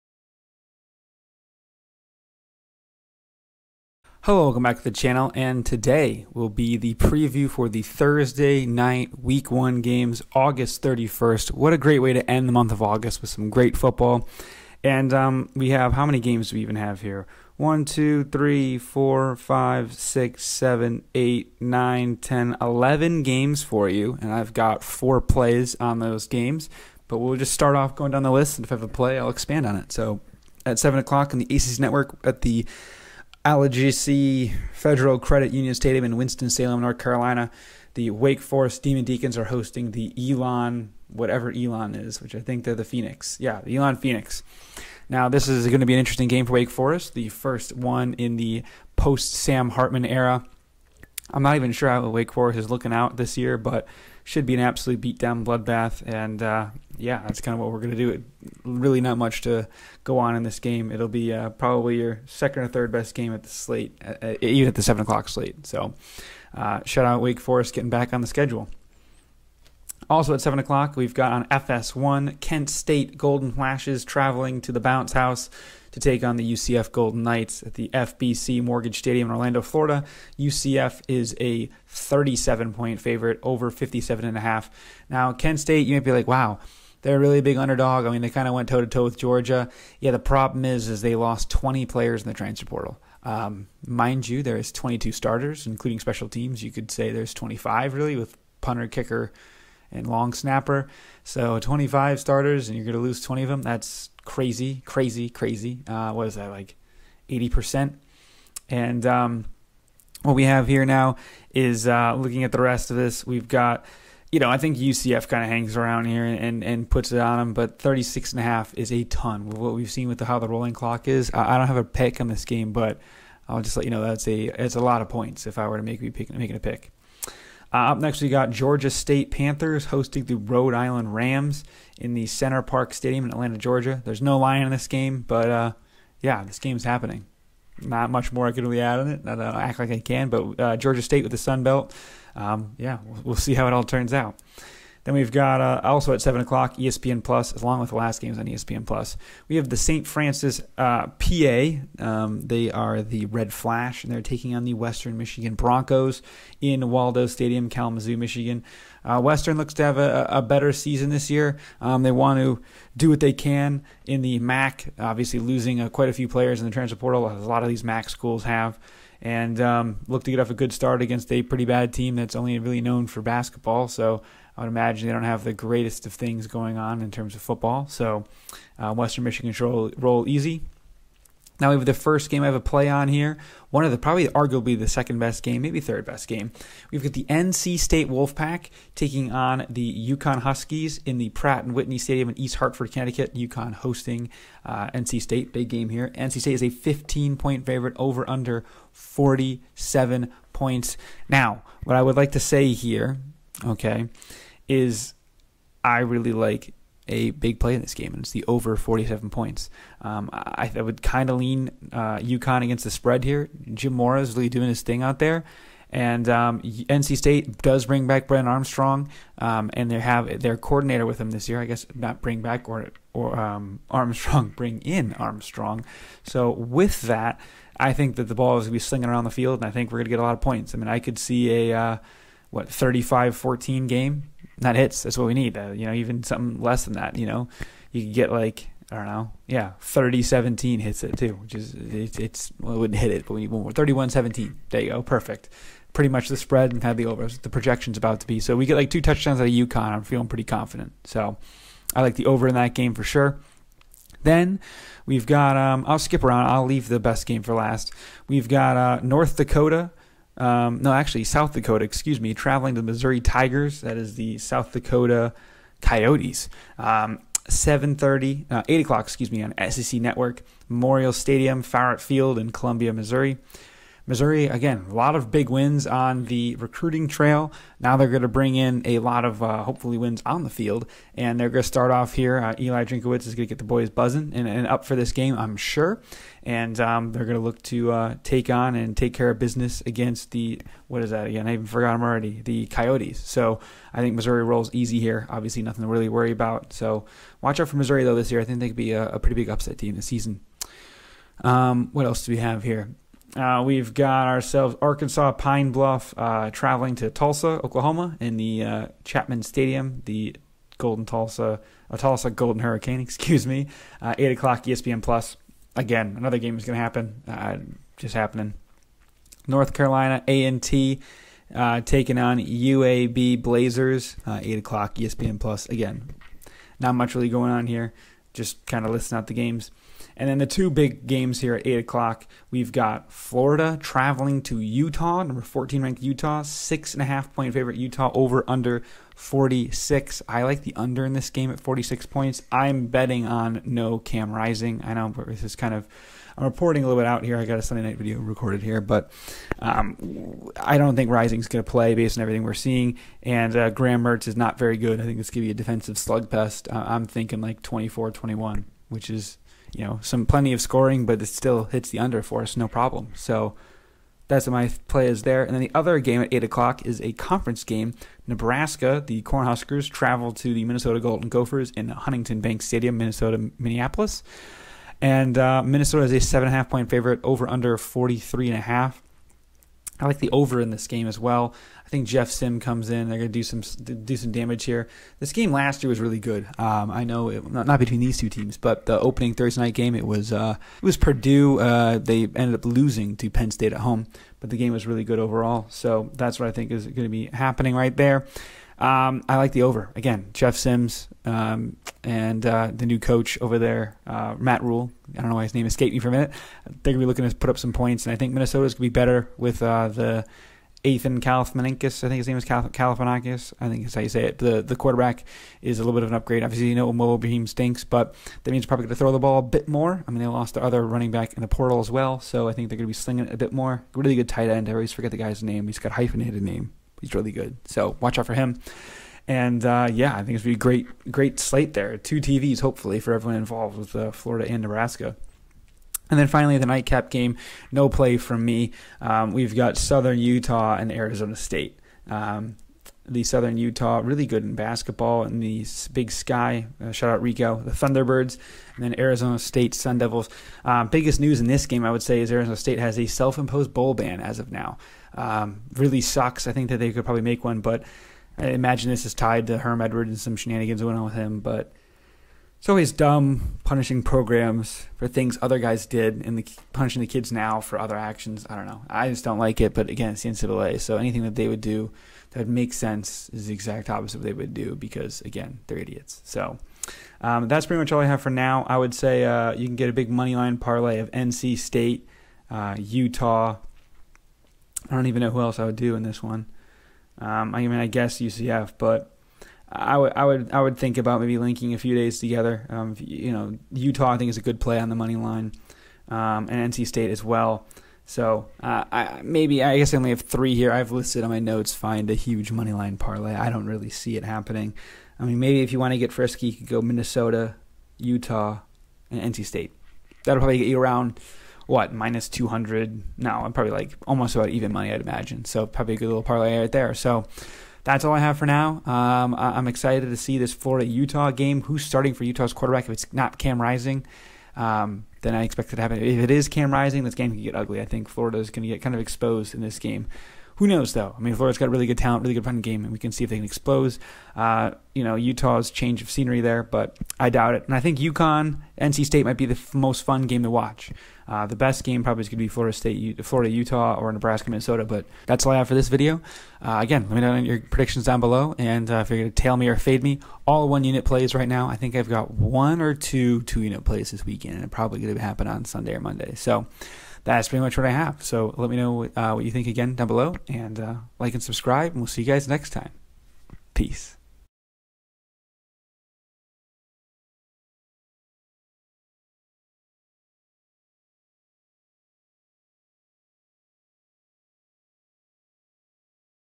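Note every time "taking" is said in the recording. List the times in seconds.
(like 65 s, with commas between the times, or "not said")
154 s, 188 s, 321 s.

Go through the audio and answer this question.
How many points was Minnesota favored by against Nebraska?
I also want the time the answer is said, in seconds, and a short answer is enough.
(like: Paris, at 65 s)
7.5, at 376 s.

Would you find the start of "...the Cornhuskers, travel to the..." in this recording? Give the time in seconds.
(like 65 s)
369 s.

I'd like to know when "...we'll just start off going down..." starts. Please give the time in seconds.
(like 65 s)
27 s.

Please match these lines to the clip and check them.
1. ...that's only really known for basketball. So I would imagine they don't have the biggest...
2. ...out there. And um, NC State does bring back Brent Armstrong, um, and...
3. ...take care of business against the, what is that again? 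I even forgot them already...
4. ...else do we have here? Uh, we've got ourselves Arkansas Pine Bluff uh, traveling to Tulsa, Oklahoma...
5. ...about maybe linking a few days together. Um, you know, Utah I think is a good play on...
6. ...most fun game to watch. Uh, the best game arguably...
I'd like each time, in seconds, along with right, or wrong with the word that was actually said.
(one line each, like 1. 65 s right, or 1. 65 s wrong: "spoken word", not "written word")
1. 172 s wrong: "greatest", not "biggest"
2. 215 s right
3. 288 s right
4. 302 s right
5. 490 s right
6. 539 s wrong: "probably", not "arguably".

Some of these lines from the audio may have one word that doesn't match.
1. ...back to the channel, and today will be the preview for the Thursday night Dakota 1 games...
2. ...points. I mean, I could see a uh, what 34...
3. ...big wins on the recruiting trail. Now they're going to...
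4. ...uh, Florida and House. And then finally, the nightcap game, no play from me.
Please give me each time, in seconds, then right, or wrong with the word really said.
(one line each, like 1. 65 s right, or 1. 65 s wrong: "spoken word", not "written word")
1. 4 s wrong: "Week", not "Dakota"
2. 230 s wrong: "35", not "34"
3. 275 s right
4. 433 s wrong: "Nebraska", not "House".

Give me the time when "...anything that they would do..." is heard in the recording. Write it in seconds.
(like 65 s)
470 s.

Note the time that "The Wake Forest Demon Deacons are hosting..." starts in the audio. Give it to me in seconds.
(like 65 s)
37 s.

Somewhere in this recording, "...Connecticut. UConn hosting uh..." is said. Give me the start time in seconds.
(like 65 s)
192 s.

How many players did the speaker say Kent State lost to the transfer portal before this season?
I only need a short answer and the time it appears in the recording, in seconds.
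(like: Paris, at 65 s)
20, at 91 s.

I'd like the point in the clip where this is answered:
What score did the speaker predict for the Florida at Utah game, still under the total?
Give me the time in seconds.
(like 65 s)
357 s.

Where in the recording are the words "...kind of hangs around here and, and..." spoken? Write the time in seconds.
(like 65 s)
115 s.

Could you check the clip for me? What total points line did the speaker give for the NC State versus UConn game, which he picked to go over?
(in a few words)
47.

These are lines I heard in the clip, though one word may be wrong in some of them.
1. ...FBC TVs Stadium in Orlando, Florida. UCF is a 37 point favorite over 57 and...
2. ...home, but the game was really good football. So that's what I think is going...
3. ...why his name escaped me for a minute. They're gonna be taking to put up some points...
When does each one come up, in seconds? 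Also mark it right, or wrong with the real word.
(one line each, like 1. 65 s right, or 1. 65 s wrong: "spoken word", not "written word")
1. 77 s wrong: "Mortgage", not "TVs"
2. 393 s wrong: "overall", not "football"
3. 405 s wrong: "looking", not "taking".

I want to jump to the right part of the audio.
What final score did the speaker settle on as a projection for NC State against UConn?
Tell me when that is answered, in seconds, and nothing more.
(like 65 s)
243 s.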